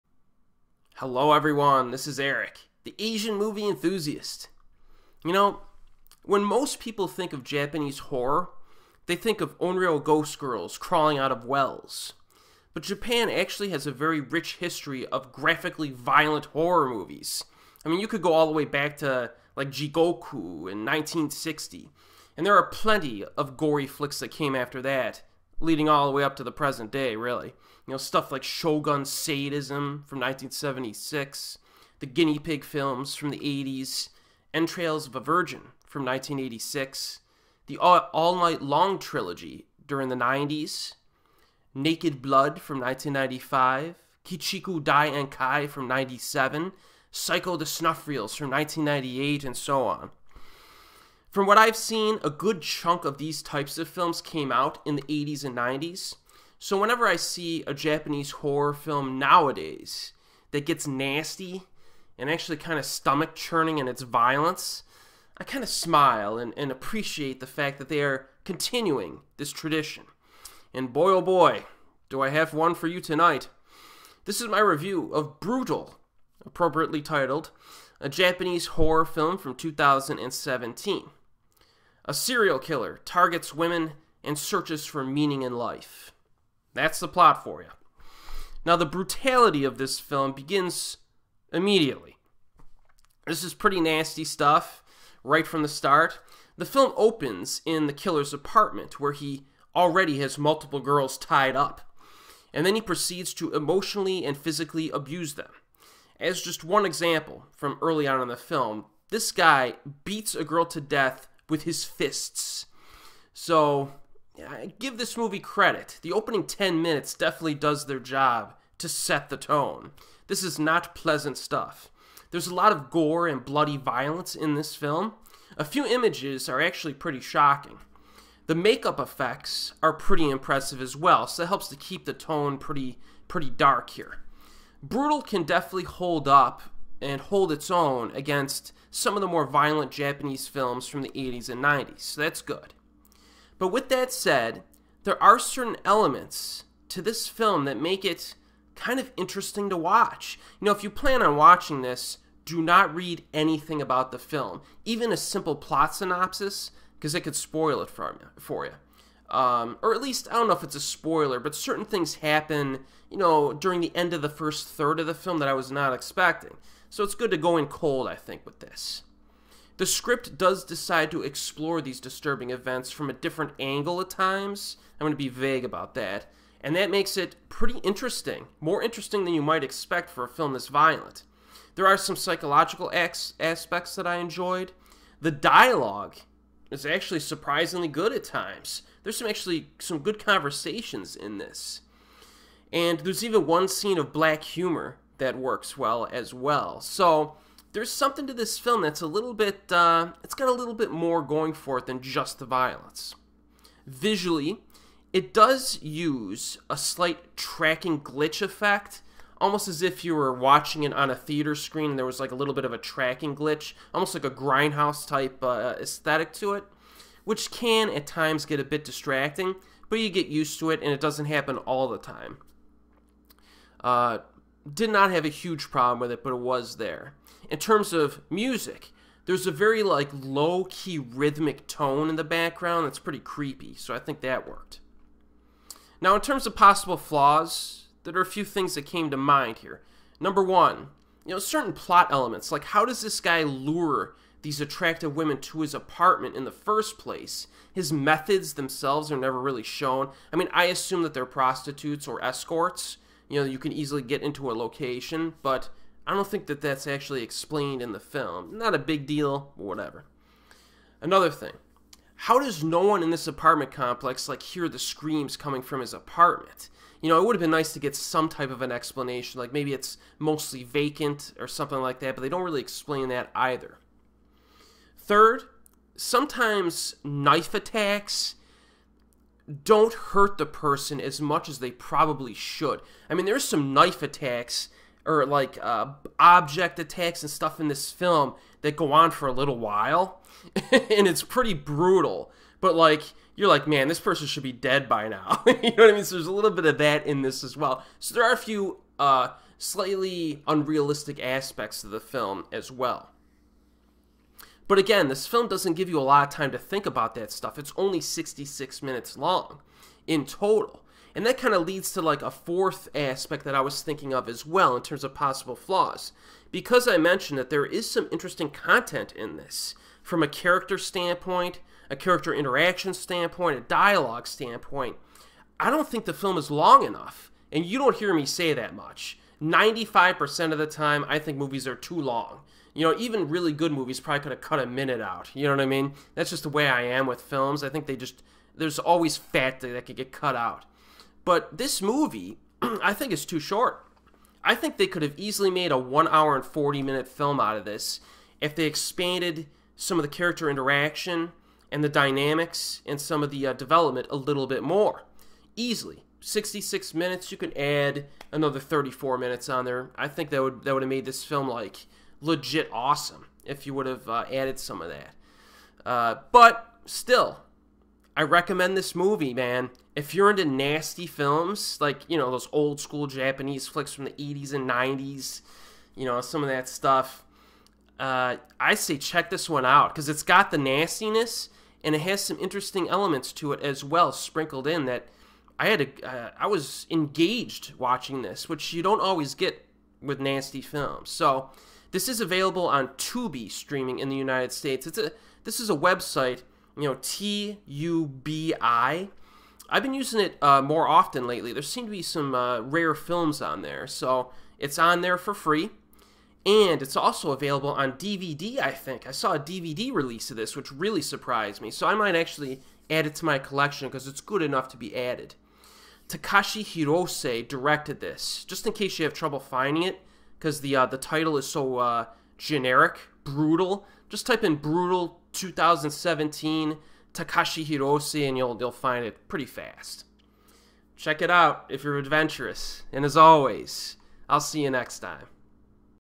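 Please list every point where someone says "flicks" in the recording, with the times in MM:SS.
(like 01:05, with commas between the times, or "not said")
00:23, 06:13.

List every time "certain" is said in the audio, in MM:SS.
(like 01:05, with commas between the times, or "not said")
02:25, 02:41, 04:01.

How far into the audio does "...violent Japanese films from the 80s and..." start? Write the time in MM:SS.
02:19.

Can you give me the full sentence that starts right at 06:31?
So, this is available on Tubi streaming in the United States.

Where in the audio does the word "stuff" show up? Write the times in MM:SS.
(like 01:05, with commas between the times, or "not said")
00:27, 01:34, 02:01, 04:47, 05:07, 06:16.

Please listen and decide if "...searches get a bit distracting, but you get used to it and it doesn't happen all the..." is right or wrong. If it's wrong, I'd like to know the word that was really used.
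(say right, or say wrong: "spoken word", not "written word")
wrong: "times", not "searches".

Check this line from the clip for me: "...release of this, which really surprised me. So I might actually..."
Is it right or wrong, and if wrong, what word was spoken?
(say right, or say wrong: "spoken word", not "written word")
right.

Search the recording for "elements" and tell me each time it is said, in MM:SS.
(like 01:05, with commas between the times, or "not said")
02:25, 04:02, 06:22.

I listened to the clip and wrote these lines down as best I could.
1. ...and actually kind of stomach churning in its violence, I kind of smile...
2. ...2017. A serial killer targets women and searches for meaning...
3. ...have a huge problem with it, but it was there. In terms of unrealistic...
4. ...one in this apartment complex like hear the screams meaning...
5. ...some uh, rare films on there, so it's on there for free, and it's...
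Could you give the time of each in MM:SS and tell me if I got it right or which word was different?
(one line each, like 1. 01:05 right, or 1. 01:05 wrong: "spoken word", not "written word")
1. 01:02 right
2. 01:19 right
3. 03:45 wrong: "music", not "unrealistic"
4. 04:22 wrong: "coming", not "meaning"
5. 06:42 right.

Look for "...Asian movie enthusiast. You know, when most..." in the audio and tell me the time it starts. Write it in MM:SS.
00:02.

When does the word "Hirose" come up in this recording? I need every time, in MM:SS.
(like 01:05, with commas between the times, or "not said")
06:56, 07:07.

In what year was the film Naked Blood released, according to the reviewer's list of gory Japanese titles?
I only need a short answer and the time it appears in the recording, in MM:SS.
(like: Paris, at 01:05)
1995, at 00:42.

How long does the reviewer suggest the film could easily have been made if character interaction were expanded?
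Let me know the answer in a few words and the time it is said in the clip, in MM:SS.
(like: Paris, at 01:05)
1 hour 40 minutes, at 05:45.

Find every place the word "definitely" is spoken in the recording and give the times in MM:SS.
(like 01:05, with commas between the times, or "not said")
01:57, 02:15.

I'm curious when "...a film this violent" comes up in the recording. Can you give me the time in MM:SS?
03:00.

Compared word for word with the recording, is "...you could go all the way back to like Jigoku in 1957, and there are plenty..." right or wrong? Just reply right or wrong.
wrong.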